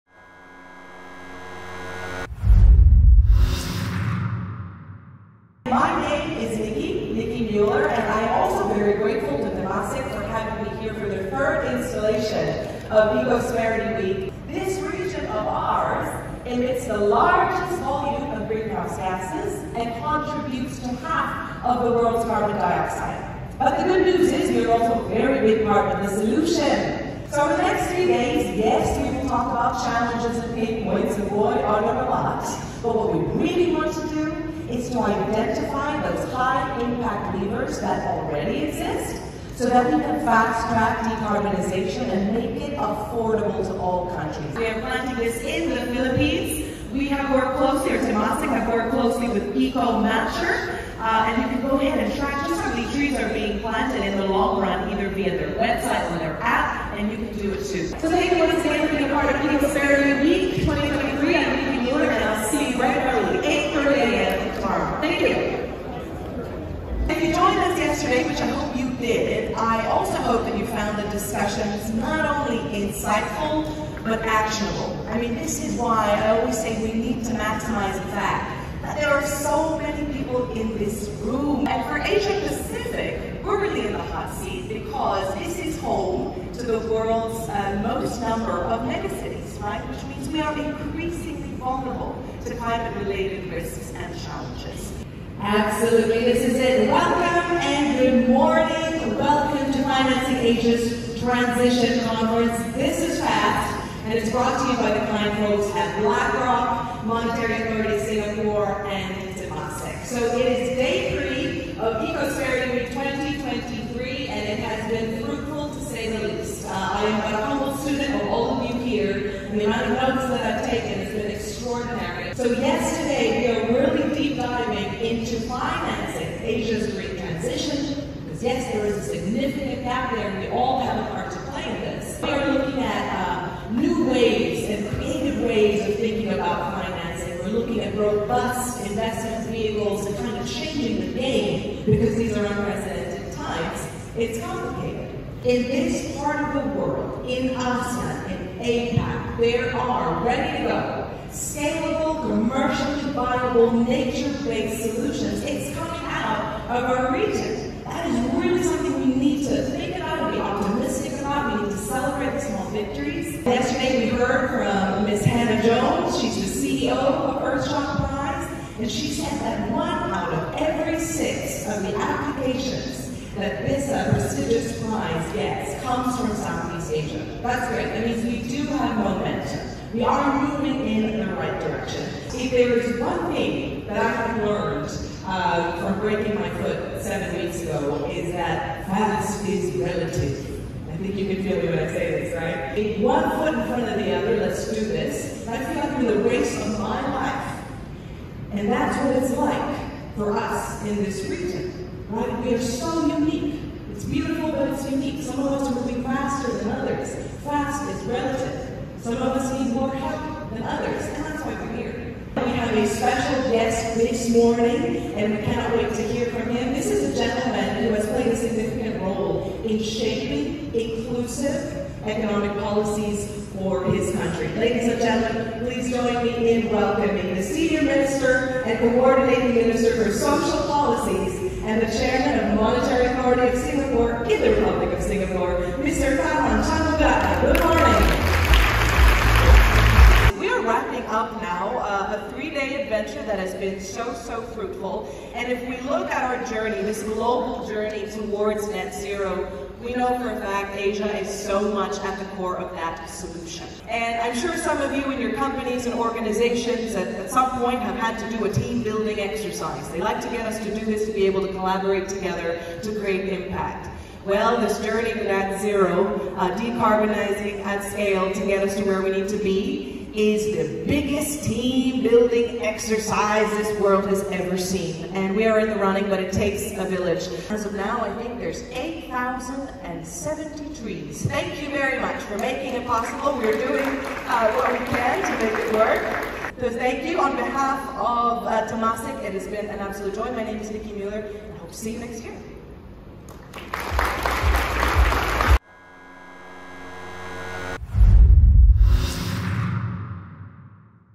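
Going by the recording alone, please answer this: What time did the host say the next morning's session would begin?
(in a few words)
8:30 a.m.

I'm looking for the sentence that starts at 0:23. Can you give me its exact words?
But the good news is we're also a very big part of the solution.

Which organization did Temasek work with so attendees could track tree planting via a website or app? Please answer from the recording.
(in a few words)
EcoMatcher.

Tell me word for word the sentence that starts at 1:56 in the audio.
Uh, I am a humble student of all of you here, and the amount of notes that I've taken has been extraordinary.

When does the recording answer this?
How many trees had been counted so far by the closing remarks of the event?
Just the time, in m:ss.
4:38.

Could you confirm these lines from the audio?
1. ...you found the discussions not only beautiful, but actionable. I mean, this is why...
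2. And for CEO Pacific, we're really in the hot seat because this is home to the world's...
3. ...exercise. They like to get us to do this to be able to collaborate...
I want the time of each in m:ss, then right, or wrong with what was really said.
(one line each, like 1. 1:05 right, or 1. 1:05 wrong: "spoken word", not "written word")
1. 1:10 wrong: "insightful", not "beautiful"
2. 1:21 wrong: "Asia", not "CEO"
3. 4:19 right.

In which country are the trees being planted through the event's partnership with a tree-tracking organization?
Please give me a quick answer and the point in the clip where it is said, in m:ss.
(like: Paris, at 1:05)
Philippines, at 0:45.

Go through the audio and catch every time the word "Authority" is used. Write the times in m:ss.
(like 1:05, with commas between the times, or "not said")
1:47, 3:53.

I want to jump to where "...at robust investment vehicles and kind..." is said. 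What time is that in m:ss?
2:17.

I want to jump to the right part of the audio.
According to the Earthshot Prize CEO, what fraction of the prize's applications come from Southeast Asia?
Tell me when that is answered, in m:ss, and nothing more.
2:49.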